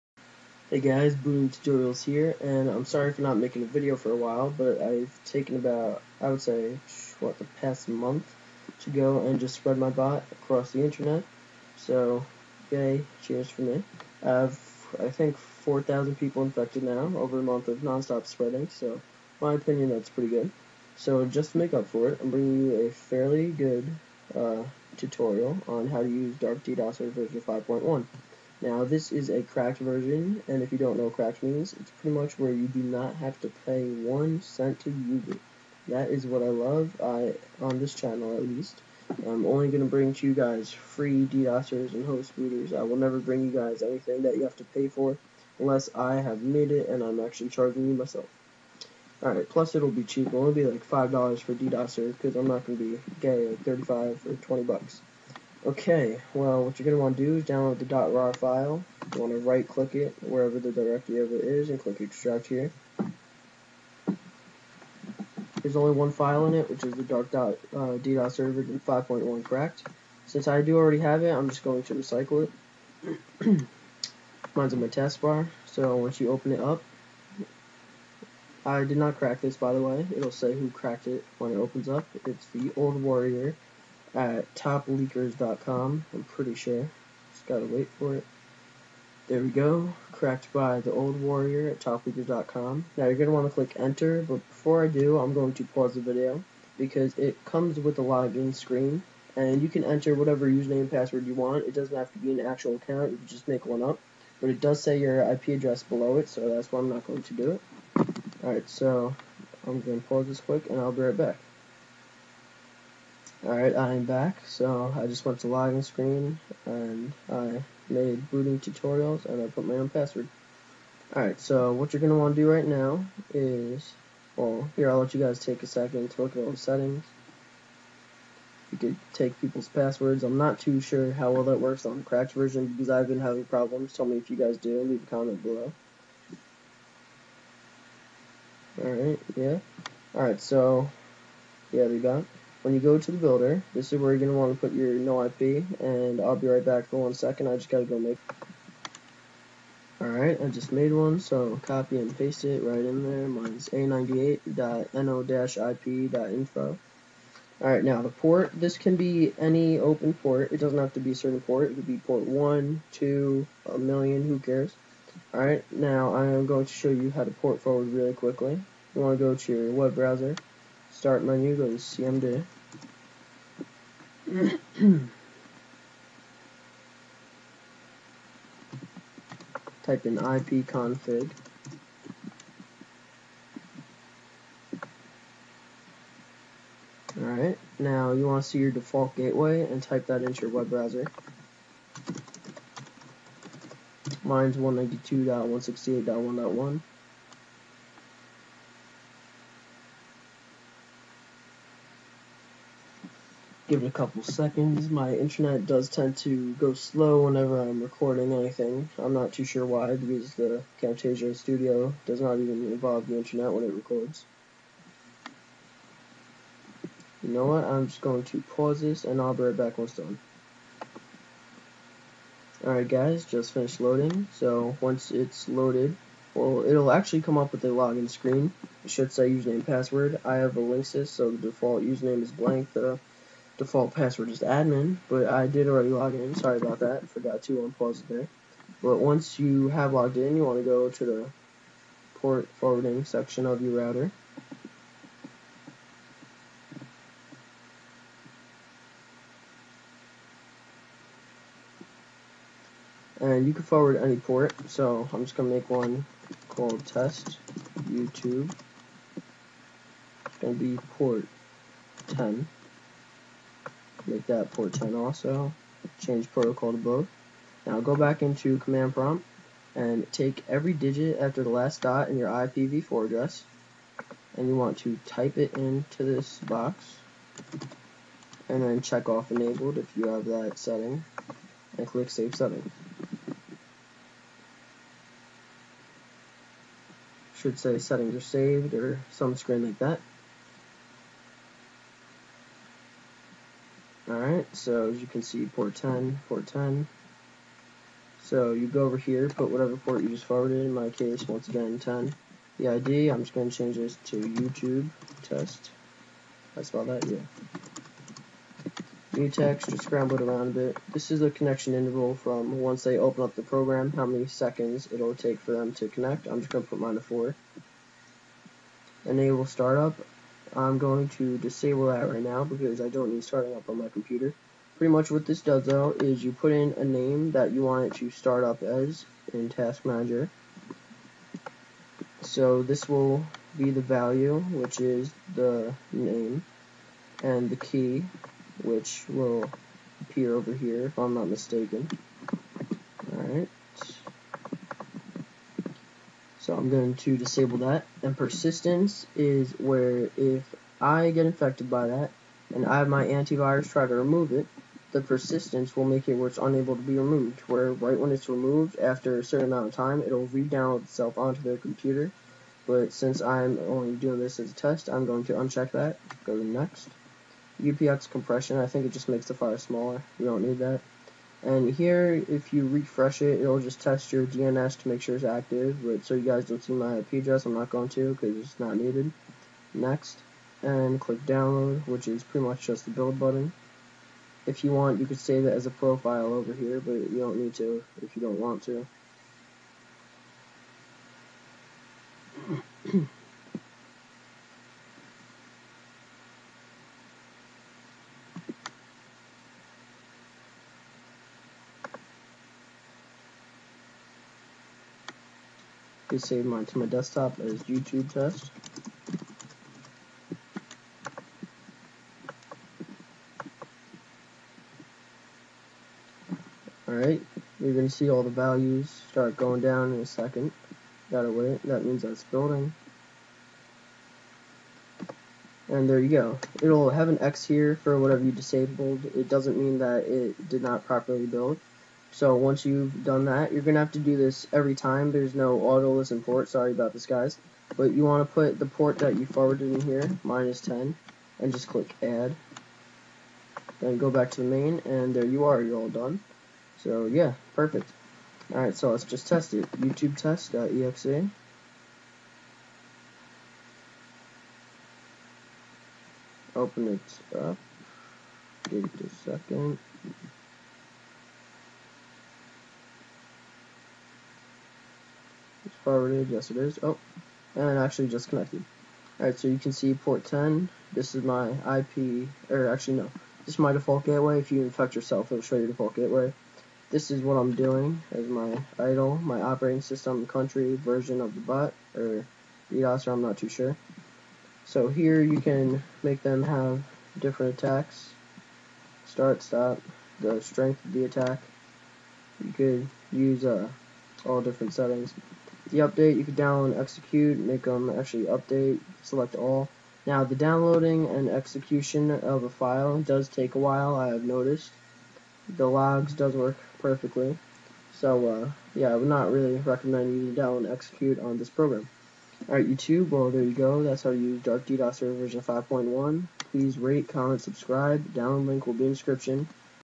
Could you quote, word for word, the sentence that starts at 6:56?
Alright, you're going to see all the values start going down in a second.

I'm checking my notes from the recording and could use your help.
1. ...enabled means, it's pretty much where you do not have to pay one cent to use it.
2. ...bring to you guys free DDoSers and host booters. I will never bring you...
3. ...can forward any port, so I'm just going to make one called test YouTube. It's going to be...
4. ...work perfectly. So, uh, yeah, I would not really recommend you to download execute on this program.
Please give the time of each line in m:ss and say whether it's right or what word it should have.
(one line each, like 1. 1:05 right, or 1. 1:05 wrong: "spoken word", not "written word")
1. 0:31 wrong: "cracked", not "enabled"
2. 0:39 right
3. 4:13 right
4. 8:26 right.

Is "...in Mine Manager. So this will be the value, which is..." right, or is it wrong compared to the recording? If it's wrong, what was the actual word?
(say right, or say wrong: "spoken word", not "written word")
wrong: "Task", not "Mine".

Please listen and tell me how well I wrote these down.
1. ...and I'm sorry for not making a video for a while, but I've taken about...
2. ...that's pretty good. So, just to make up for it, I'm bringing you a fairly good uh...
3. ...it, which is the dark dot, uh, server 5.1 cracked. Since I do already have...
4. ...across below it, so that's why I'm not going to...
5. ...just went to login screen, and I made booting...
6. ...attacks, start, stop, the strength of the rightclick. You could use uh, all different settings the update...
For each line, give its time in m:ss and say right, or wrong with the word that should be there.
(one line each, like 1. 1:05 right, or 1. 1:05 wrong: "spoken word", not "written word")
1. 0:02 right
2. 0:19 right
3. 1:06 right
4. 1:45 wrong: "address", not "across"
5. 1:55 right
6. 8:07 wrong: "attack", not "rightclick".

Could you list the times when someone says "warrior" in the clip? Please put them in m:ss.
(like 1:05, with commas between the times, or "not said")
1:23, 1:31.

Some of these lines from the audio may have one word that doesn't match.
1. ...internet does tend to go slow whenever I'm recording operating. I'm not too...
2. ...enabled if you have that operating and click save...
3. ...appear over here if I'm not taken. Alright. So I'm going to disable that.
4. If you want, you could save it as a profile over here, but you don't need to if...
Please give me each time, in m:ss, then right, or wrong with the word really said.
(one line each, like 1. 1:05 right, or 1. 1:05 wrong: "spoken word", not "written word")
1. 3:25 wrong: "anything", not "operating"
2. 4:39 wrong: "setting", not "operating"
3. 5:40 wrong: "mistaken", not "taken"
4. 6:24 right.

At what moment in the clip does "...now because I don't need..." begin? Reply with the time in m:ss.
5:22.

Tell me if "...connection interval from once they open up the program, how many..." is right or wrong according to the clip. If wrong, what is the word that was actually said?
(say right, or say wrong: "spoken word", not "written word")
right.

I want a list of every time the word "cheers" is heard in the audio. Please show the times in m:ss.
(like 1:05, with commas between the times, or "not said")
0:13.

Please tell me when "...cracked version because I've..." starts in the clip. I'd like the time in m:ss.
2:12.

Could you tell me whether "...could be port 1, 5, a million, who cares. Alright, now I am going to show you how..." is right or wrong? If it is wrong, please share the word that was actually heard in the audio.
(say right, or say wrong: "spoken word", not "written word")
wrong: "2", not "5".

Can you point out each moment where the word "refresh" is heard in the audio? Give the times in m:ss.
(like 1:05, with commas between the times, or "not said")
6:12.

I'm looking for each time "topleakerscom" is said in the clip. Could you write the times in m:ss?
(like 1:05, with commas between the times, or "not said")
1:24, 1:31.